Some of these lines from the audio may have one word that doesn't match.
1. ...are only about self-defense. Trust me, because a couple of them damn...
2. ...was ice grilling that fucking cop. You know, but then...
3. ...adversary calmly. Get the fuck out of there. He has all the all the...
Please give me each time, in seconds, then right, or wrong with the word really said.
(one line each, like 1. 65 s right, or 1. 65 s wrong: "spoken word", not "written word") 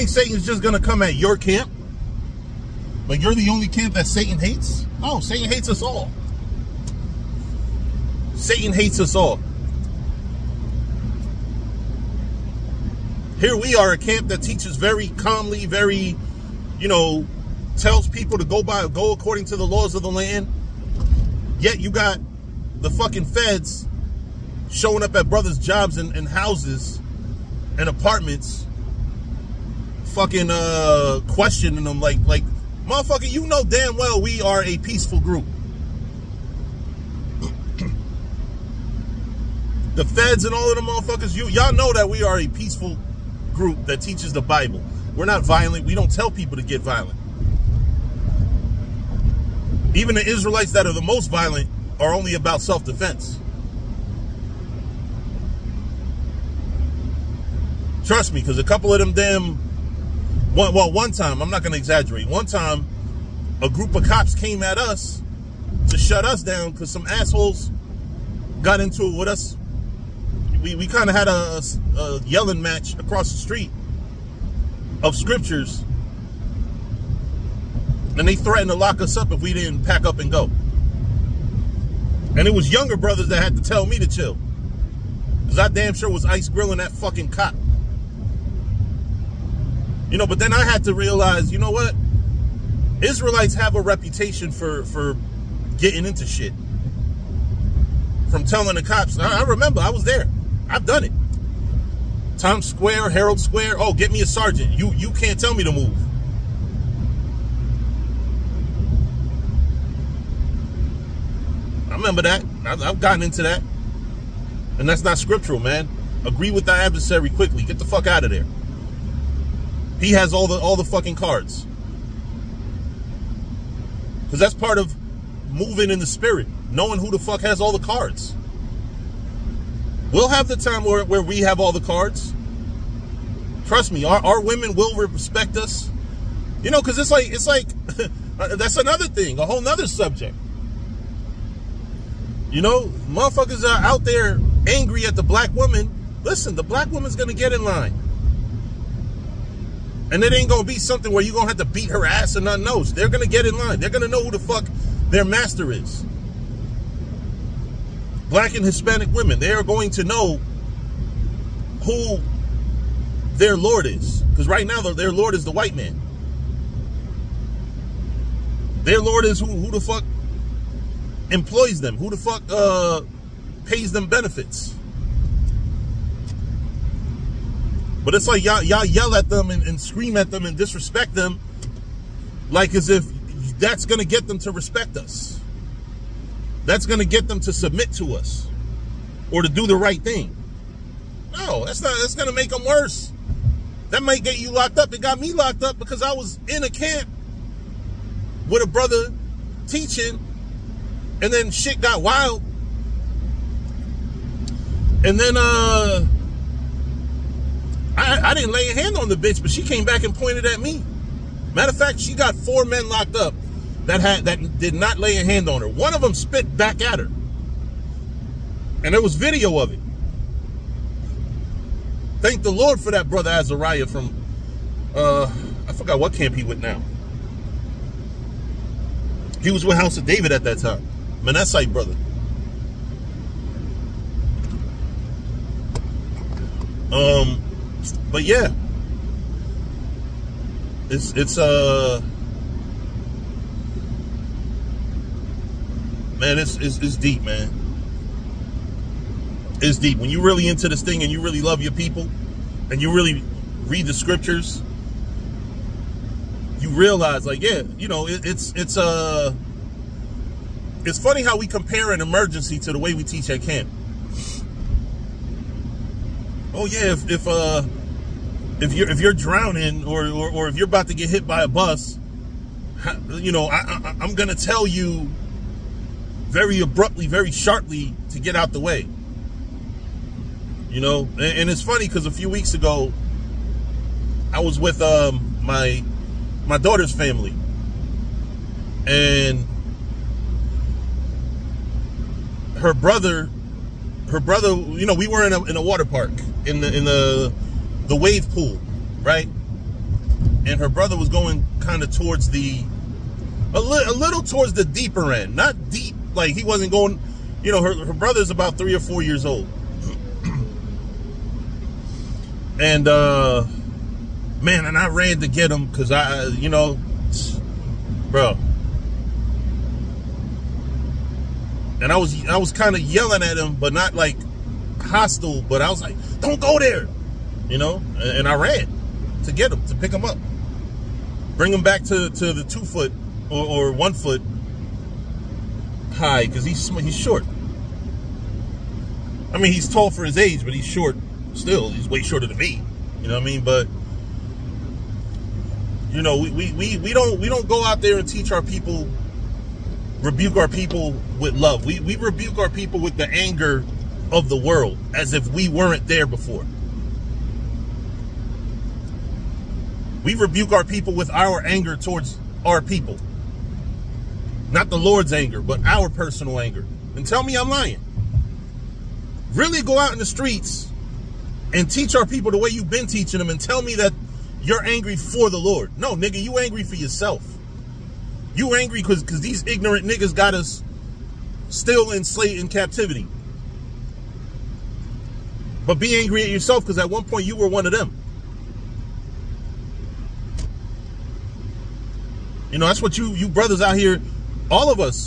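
1. 51 s right
2. 86 s right
3. 116 s wrong: "quickly", not "calmly".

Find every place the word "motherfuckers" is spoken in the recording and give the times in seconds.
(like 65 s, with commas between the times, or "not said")
32 s, 40 s, 143 s.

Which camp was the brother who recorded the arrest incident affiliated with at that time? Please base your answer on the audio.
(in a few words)
House of David.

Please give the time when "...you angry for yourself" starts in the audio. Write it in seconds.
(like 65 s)
376 s.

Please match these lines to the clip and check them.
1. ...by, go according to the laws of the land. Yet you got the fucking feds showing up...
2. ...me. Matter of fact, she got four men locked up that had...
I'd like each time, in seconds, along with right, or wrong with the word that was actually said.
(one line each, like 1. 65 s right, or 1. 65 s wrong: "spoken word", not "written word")
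1. 18 s right
2. 210 s right.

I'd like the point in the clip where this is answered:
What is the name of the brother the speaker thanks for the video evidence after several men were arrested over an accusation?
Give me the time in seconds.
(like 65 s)
223 s.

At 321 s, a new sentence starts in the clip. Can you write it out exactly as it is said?
And I was I was kind of yelling at him, but not like hostile.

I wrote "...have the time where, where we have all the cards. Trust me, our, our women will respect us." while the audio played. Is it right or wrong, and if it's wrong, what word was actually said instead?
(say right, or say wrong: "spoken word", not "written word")
right.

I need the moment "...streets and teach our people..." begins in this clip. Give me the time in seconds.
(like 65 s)
370 s.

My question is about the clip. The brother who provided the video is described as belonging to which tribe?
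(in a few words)
Manasseh.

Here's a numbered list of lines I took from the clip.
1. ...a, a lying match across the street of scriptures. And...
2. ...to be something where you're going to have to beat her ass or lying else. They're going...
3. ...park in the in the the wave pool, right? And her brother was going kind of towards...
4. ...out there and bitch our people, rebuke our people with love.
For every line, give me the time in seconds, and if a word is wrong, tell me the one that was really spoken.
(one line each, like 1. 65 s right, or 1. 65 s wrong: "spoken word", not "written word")
1. 71 s wrong: "yelling", not "lying"
2. 150 s wrong: "nothing", not "lying"
3. 295 s right
4. 347 s wrong: "teach", not "bitch".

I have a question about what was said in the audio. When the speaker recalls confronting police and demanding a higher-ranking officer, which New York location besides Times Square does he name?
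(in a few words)
Herald Square.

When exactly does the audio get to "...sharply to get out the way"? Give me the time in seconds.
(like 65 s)
277 s.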